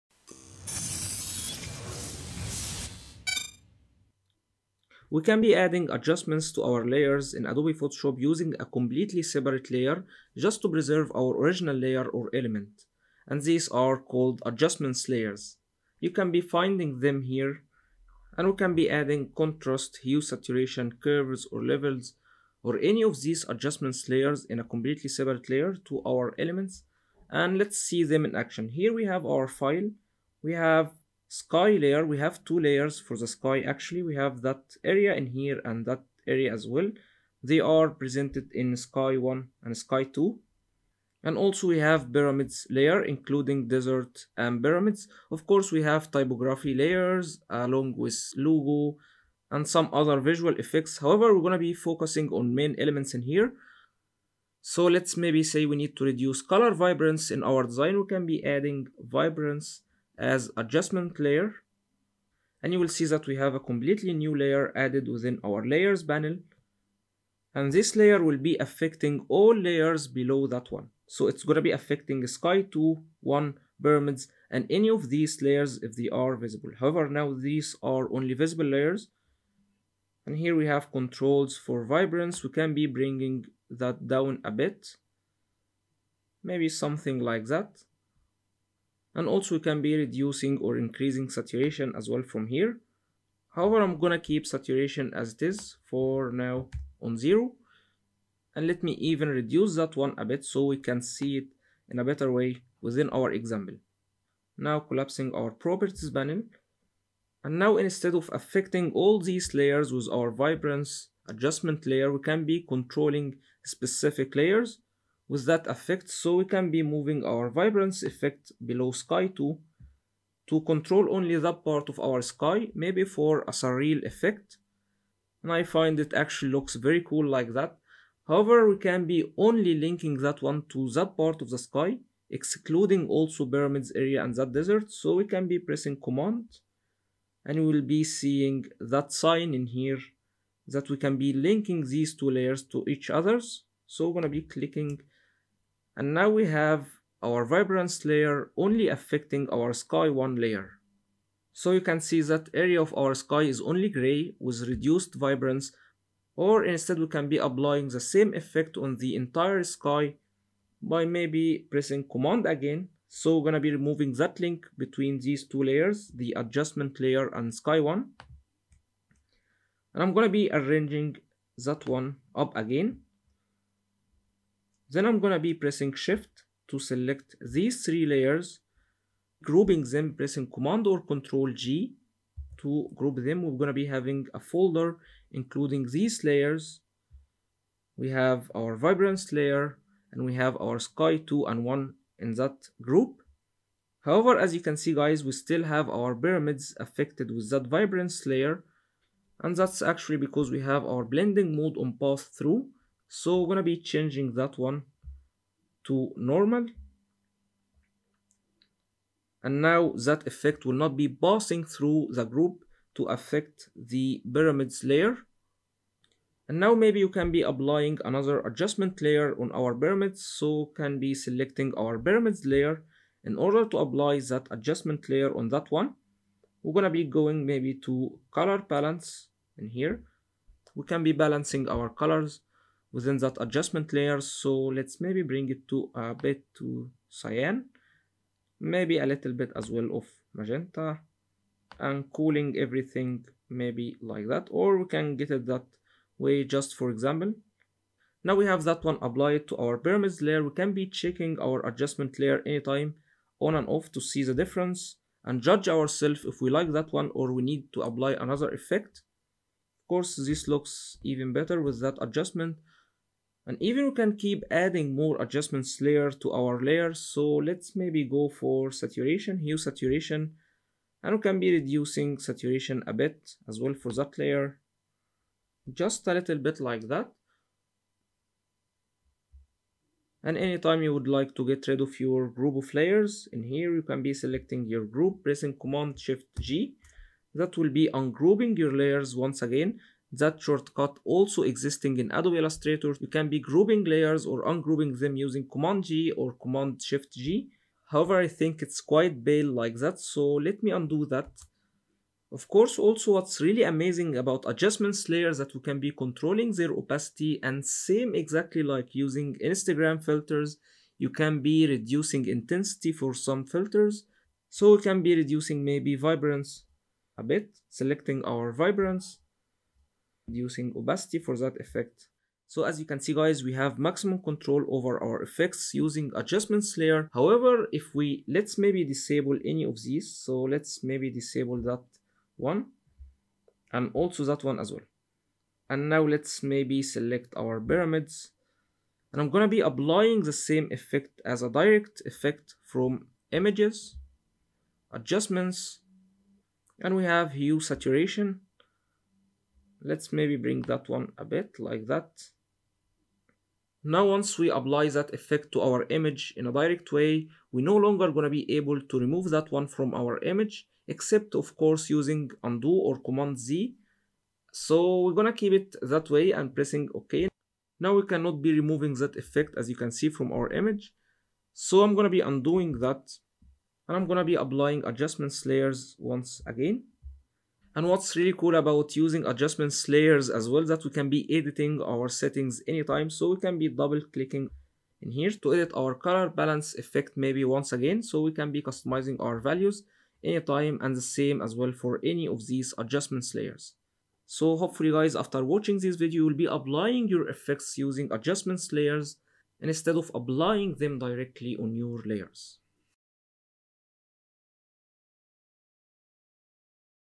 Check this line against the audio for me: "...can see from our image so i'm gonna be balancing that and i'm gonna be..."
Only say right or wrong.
wrong.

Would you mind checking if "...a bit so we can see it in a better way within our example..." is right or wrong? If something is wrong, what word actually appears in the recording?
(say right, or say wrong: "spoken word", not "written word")
right.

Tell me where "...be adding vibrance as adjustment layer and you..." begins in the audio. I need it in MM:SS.
00:58.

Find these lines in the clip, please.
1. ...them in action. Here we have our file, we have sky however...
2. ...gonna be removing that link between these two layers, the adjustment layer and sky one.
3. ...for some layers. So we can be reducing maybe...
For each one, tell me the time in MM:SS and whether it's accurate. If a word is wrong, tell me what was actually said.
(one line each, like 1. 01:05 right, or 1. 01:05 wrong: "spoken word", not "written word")
1. 00:28 wrong: "layer", not "however"
2. 02:43 right
3. 05:12 wrong: "filters", not "layers".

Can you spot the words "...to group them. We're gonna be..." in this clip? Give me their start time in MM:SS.
03:02.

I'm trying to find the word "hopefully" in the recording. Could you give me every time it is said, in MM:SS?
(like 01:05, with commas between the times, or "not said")
06:34.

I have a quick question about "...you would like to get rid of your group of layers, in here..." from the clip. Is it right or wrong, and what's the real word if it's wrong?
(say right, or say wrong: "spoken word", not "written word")
right.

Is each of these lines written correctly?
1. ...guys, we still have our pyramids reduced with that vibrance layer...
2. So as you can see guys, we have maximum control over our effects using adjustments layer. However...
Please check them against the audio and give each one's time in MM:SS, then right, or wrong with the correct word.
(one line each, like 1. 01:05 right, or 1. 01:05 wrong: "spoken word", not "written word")
1. 03:14 wrong: "affected", not "reduced"
2. 05:22 right.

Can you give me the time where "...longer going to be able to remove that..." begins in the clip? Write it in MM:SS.
05:57.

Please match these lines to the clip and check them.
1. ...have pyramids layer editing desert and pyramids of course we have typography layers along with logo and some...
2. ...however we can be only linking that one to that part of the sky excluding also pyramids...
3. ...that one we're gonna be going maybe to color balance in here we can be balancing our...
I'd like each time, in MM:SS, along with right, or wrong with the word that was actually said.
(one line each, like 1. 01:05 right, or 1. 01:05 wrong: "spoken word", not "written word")
1. 00:41 wrong: "including", not "editing"
2. 02:08 right
3. 03:45 right.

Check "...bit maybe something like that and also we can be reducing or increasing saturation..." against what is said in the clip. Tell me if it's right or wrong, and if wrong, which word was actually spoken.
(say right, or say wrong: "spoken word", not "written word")
right.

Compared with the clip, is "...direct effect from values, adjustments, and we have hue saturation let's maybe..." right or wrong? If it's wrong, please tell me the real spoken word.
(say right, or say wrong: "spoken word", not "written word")
wrong: "images", not "values".